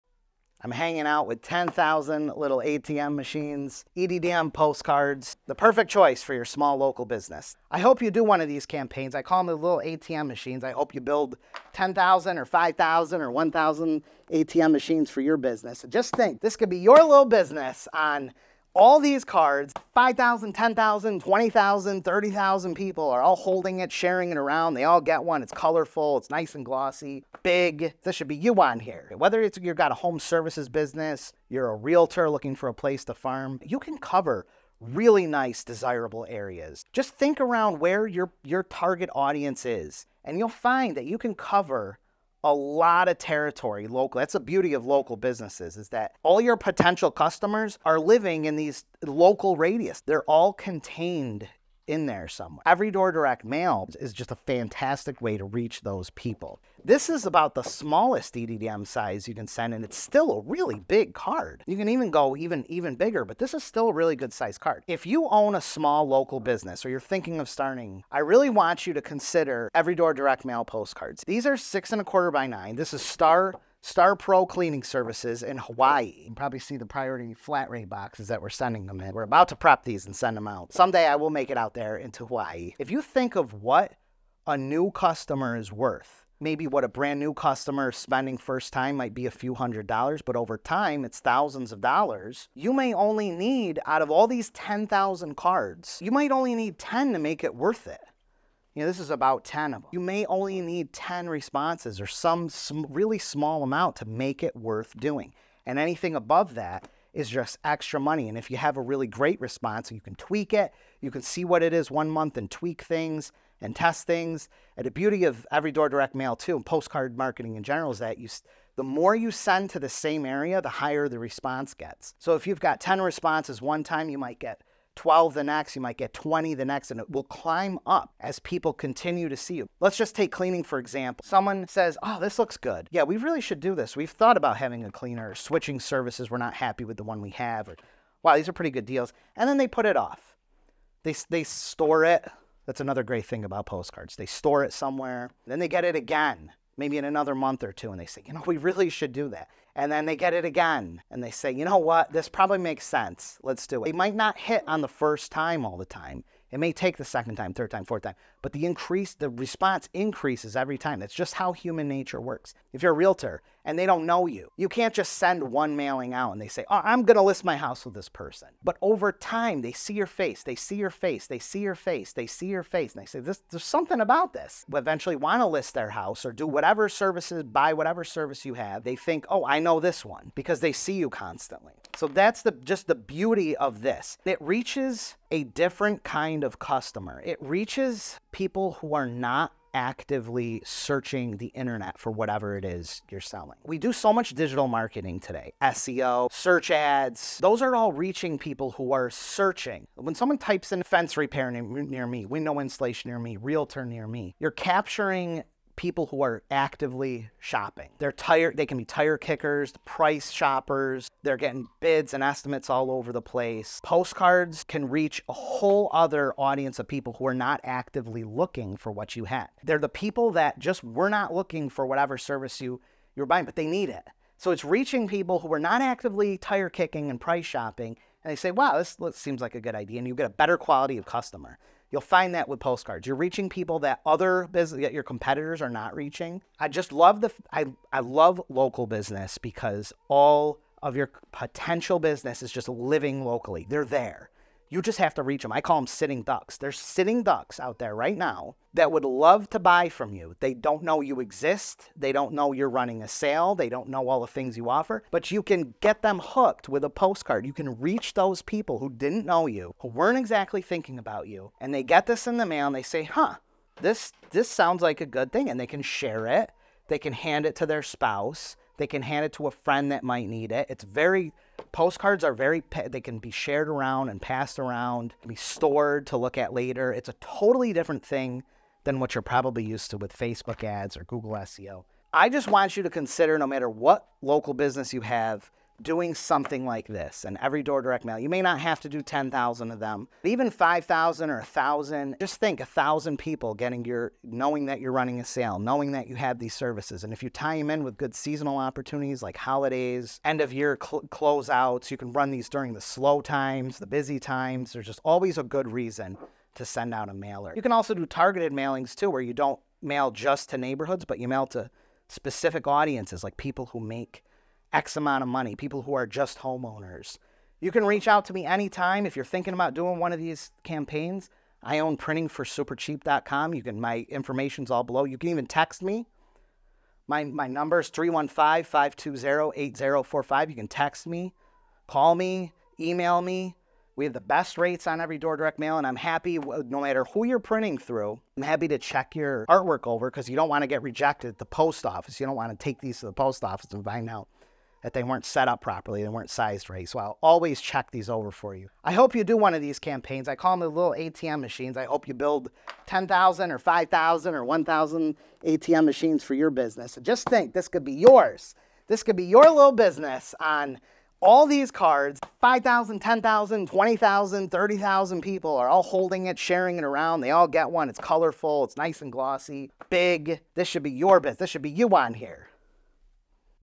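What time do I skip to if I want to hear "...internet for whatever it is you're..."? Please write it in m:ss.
3:11.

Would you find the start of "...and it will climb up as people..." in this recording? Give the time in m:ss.
2:06.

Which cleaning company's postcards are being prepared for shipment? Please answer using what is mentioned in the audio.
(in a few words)
Star Pro Cleaning Services.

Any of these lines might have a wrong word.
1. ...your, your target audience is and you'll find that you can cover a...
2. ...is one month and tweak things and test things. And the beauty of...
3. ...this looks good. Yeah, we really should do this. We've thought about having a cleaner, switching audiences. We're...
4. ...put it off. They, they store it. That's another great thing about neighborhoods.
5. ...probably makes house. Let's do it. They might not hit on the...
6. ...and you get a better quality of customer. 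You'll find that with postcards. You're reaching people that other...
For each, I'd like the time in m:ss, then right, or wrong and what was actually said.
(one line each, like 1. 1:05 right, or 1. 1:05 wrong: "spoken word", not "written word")
1. 0:38 right
2. 1:51 right
3. 2:12 wrong: "services", not "audiences"
4. 2:19 wrong: "postcards", not "neighborhoods"
5. 2:32 wrong: "sense", not "house"
6. 3:49 right.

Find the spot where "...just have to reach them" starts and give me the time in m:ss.
4:04.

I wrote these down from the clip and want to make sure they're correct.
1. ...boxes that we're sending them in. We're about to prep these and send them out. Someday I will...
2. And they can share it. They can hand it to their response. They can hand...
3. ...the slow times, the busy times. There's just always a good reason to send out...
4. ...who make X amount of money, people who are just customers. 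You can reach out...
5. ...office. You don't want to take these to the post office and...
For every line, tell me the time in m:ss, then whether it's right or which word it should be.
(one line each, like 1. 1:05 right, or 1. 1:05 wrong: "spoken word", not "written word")
1. 1:17 right
2. 4:25 wrong: "spouse", not "response"
3. 5:02 right
4. 5:13 wrong: "homeowners", not "customers"
5. 5:41 right.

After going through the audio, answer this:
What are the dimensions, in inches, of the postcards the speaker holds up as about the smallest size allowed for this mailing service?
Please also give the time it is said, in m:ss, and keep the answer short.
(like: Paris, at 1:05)
6.25 by 9, at 1:11.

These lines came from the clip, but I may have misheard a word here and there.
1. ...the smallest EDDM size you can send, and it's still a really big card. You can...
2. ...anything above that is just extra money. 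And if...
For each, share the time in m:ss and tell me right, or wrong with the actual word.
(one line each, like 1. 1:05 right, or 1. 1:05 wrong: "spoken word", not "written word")
1. 0:57 right
2. 1:45 right.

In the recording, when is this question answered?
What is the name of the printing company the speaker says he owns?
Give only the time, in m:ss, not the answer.
5:21.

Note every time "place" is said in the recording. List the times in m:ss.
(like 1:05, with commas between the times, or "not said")
0:32, 3:33.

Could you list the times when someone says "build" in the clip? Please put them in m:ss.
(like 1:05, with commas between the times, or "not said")
0:11, 5:52.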